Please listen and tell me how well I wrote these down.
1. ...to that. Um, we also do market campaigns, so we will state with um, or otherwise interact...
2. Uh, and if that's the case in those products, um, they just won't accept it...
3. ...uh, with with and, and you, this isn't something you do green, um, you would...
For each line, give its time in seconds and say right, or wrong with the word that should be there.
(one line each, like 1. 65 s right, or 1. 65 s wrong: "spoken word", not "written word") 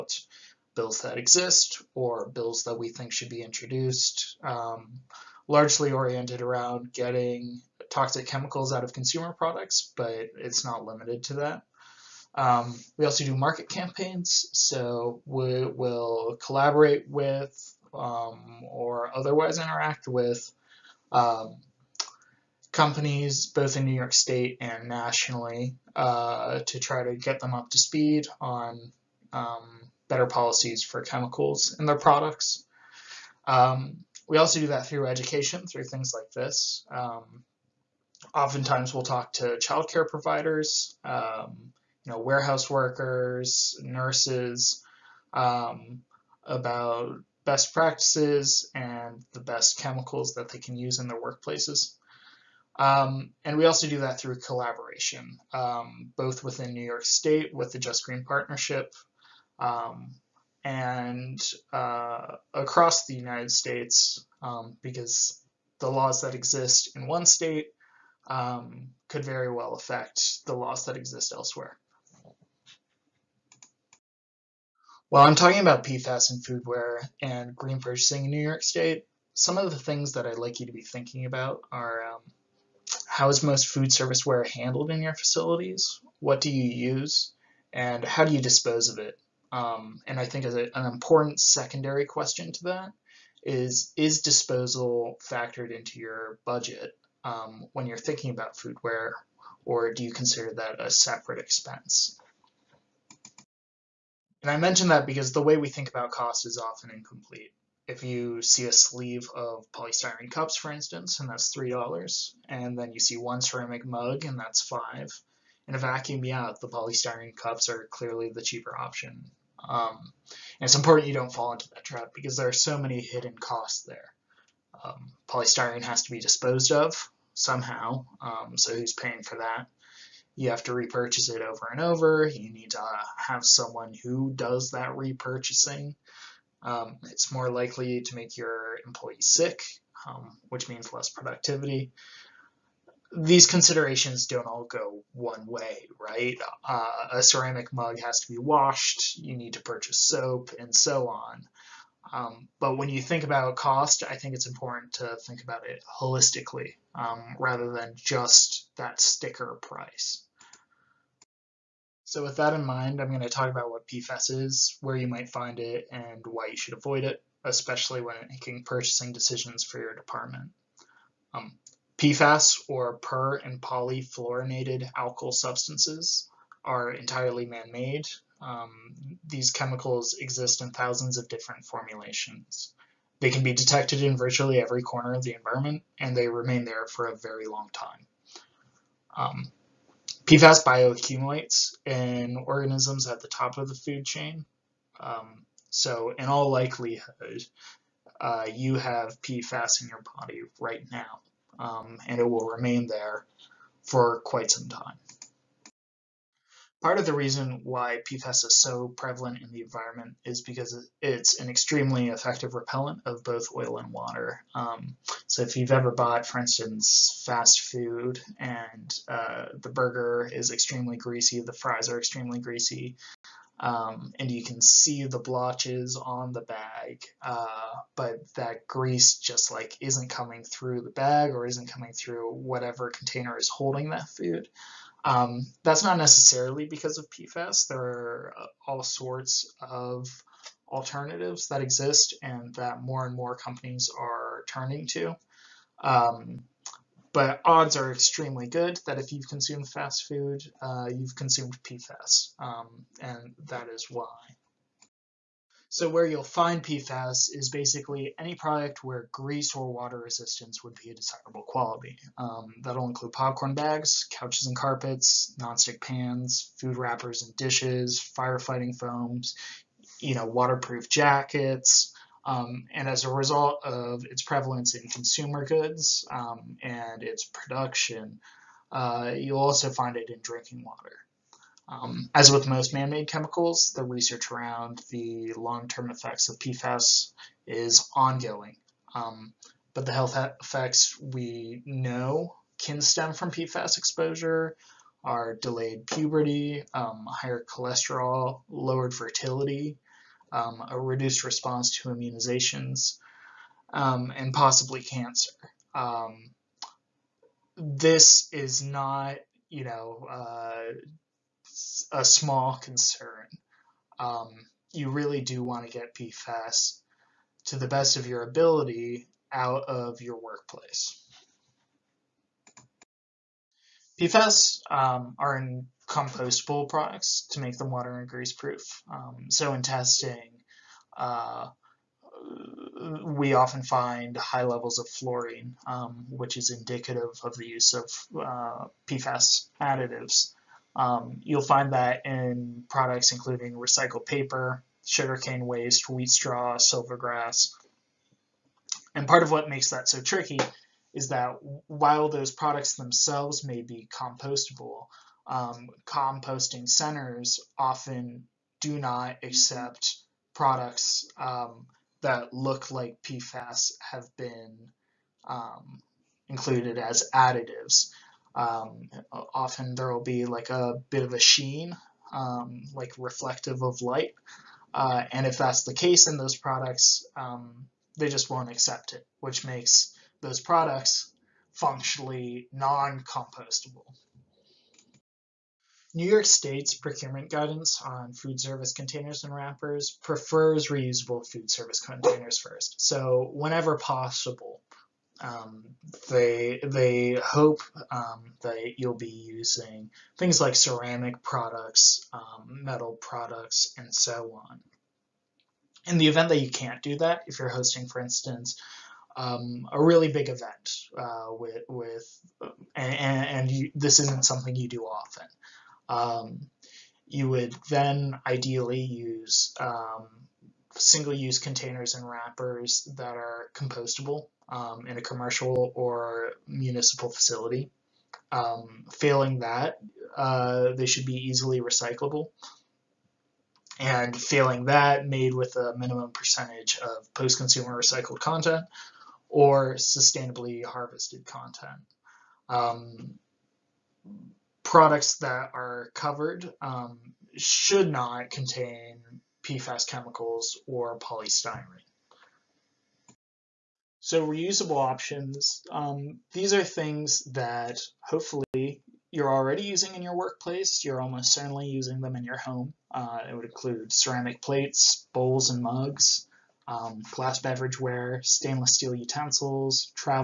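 1. 11 s wrong: "collaborate", not "state"
2. 374 s right
3. 410 s wrong: "often", not "green".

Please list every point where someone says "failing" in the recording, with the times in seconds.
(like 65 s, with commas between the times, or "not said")
428 s, 434 s.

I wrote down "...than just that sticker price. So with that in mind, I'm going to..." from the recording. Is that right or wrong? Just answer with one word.
right.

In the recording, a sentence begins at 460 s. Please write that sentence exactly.
You're almost certainly using them in your home.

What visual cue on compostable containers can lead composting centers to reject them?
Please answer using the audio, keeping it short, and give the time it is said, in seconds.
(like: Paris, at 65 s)
A sheen, at 370 s.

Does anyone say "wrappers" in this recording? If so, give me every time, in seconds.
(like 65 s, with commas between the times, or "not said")
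266 s, 389 s, 422 s.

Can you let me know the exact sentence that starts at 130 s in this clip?
You have to repurchase it over and over.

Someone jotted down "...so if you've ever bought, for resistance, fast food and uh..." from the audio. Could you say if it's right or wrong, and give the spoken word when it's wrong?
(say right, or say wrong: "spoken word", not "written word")
wrong: "instance", not "resistance".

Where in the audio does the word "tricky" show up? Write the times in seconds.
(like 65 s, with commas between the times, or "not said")
350 s.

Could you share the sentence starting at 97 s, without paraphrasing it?
um, when you're thinking about foodware, or do you consider that a separate expense?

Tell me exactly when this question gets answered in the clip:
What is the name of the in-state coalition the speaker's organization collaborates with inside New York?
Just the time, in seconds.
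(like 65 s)
57 s.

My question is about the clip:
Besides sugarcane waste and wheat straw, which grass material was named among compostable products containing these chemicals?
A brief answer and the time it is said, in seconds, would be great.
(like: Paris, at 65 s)
Silvergrass, at 346 s.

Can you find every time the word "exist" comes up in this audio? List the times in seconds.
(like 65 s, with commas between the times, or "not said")
1 s, 66 s, 70 s, 180 s, 241 s.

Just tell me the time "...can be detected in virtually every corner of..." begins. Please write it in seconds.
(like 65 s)
183 s.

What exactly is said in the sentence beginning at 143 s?
These considerations don't all go one way, right?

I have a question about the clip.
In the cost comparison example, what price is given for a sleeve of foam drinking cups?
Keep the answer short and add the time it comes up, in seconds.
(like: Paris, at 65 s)
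$3, at 111 s.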